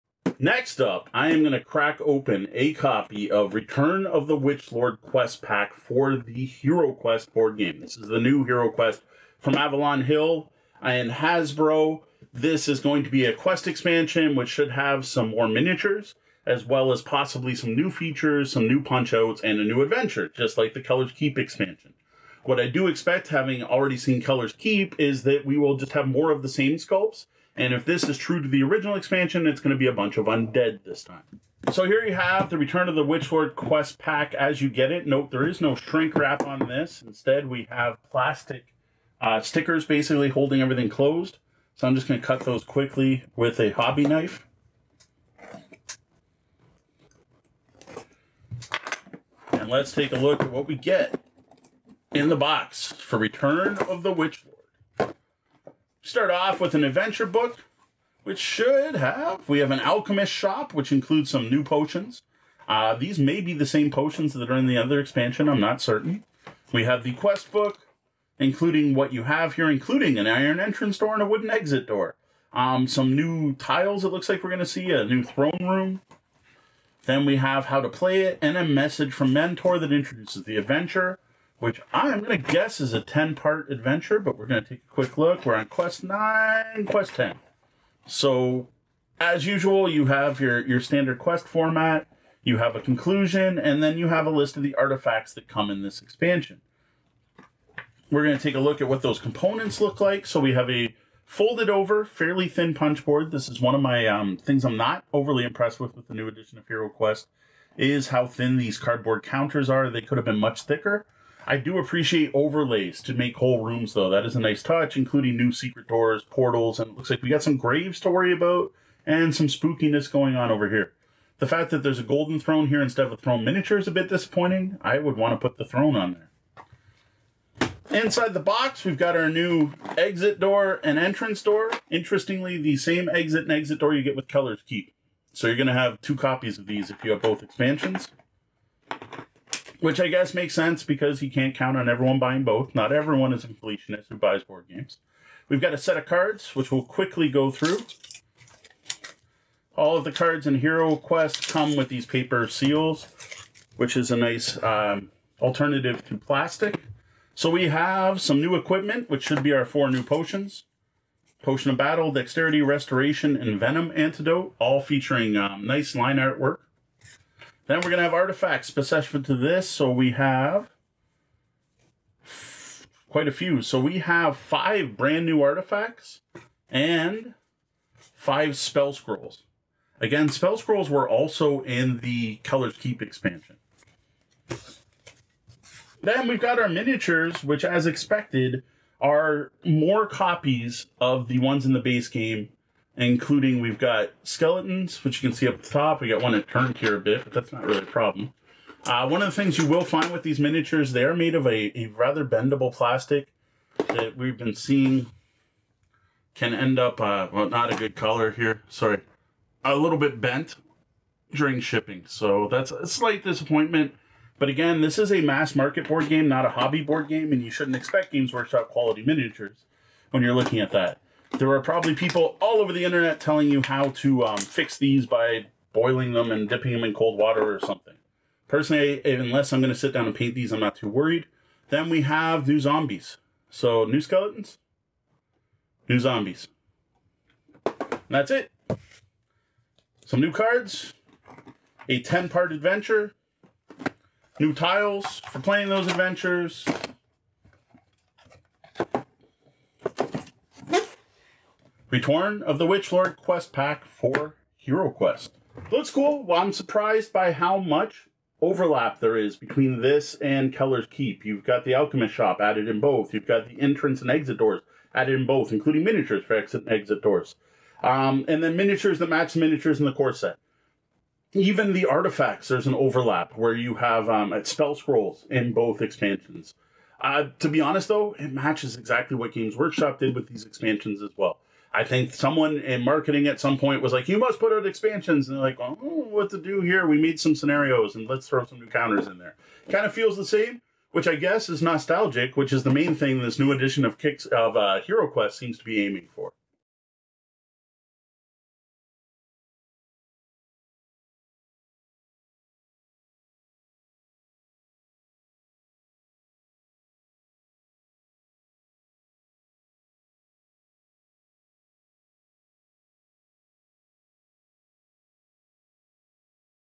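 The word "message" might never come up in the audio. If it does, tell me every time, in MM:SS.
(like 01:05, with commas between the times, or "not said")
01:18.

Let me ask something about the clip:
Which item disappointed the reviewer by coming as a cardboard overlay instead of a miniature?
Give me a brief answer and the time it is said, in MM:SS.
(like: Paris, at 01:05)
Golden throne, at 02:02.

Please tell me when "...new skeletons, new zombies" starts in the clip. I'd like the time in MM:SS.
03:53.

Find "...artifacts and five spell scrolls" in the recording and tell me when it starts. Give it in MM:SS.
02:55.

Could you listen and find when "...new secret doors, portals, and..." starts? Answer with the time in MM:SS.
01:55.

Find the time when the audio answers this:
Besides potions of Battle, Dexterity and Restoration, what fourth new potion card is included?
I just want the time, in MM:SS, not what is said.
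02:43.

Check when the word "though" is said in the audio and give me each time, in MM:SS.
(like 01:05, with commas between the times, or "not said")
01:53, 04:37.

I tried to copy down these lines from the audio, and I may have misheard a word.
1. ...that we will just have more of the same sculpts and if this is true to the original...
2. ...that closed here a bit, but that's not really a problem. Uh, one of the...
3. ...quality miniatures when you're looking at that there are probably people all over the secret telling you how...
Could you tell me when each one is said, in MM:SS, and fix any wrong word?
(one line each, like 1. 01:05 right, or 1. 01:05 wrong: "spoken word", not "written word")
1. 00:25 right
2. 03:16 wrong: "turned", not "closed"
3. 03:38 wrong: "internet", not "secret".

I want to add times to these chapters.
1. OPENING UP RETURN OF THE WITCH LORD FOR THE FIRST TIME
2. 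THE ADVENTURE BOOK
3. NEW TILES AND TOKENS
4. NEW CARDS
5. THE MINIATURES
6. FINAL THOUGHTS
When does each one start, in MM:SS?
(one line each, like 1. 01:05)
1. 00:31
2. 00:55
3. 01:37
4. 02:06
5. 03:03
6. 04:15.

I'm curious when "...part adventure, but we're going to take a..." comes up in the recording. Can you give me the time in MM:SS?
01:23.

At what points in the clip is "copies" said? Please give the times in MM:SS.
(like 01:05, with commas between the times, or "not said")
02:16, 03:10.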